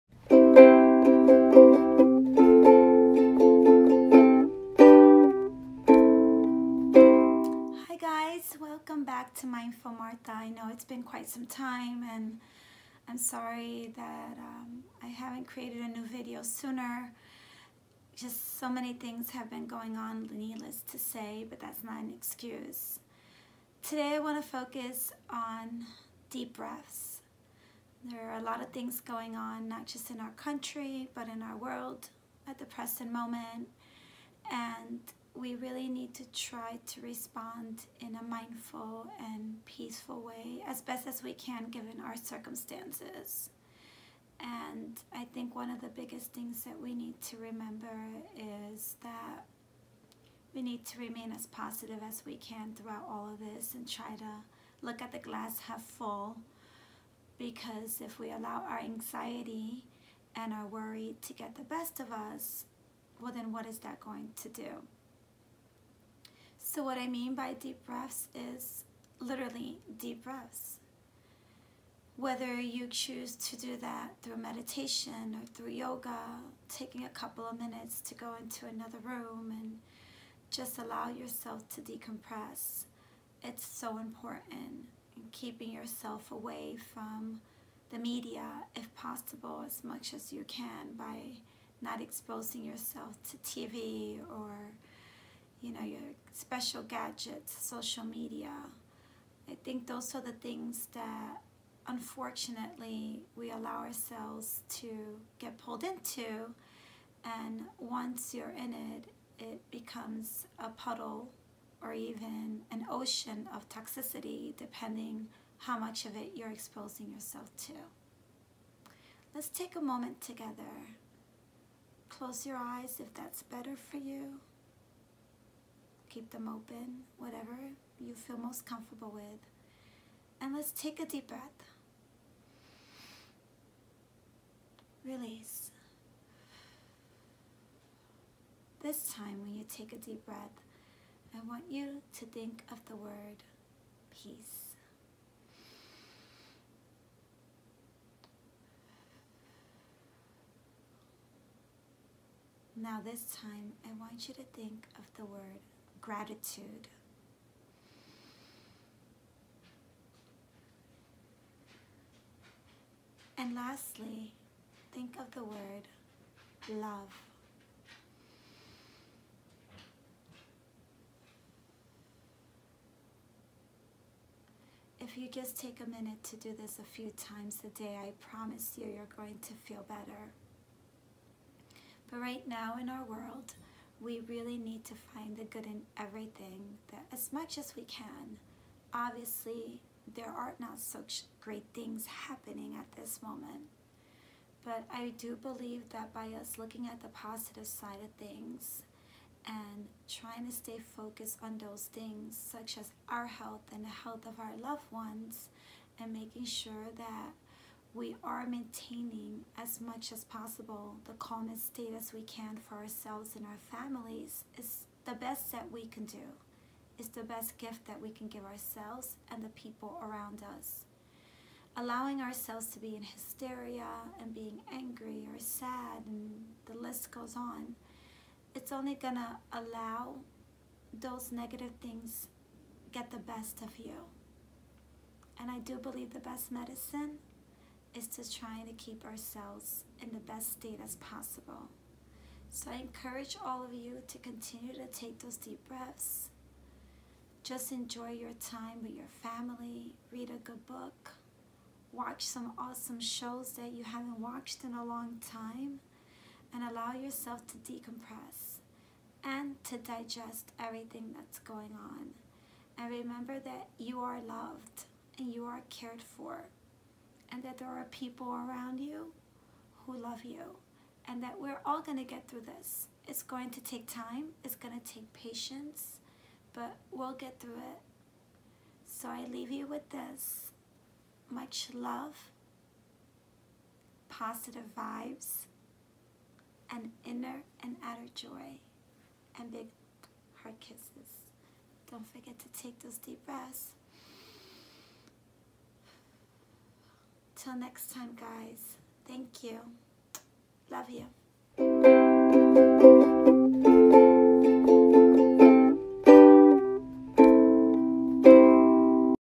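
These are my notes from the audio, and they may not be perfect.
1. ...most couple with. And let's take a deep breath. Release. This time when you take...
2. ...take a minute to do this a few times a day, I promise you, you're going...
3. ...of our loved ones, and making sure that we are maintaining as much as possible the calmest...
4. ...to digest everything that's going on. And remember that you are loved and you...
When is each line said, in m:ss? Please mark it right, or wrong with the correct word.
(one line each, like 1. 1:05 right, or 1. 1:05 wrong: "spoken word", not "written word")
1. 2:08 wrong: "comfortable", not "couple"
2. 2:55 right
3. 3:24 right
4. 4:19 right.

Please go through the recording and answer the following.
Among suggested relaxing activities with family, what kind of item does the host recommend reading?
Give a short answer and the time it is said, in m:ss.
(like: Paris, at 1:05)
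a good book, at 4:10.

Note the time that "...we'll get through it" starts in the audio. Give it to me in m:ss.
4:36.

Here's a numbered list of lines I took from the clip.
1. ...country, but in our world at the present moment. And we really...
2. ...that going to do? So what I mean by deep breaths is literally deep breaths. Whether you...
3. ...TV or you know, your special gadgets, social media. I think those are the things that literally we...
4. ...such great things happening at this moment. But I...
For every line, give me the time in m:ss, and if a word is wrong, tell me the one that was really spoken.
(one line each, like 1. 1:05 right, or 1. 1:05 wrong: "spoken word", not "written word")
1. 0:30 right
2. 1:03 right
3. 1:33 wrong: "unfortunately", not "literally"
4. 3:10 right.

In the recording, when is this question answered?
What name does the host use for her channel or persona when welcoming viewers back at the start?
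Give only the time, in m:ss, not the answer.
0:09.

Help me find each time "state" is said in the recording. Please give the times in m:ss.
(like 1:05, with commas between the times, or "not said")
3:31, 4:00.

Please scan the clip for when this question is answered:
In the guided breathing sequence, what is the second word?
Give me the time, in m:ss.
2:36.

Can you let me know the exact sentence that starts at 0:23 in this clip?
Today I want to focus on deep breaths.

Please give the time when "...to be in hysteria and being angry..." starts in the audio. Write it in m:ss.
3:42.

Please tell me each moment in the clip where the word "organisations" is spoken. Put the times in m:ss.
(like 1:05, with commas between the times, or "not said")
not said.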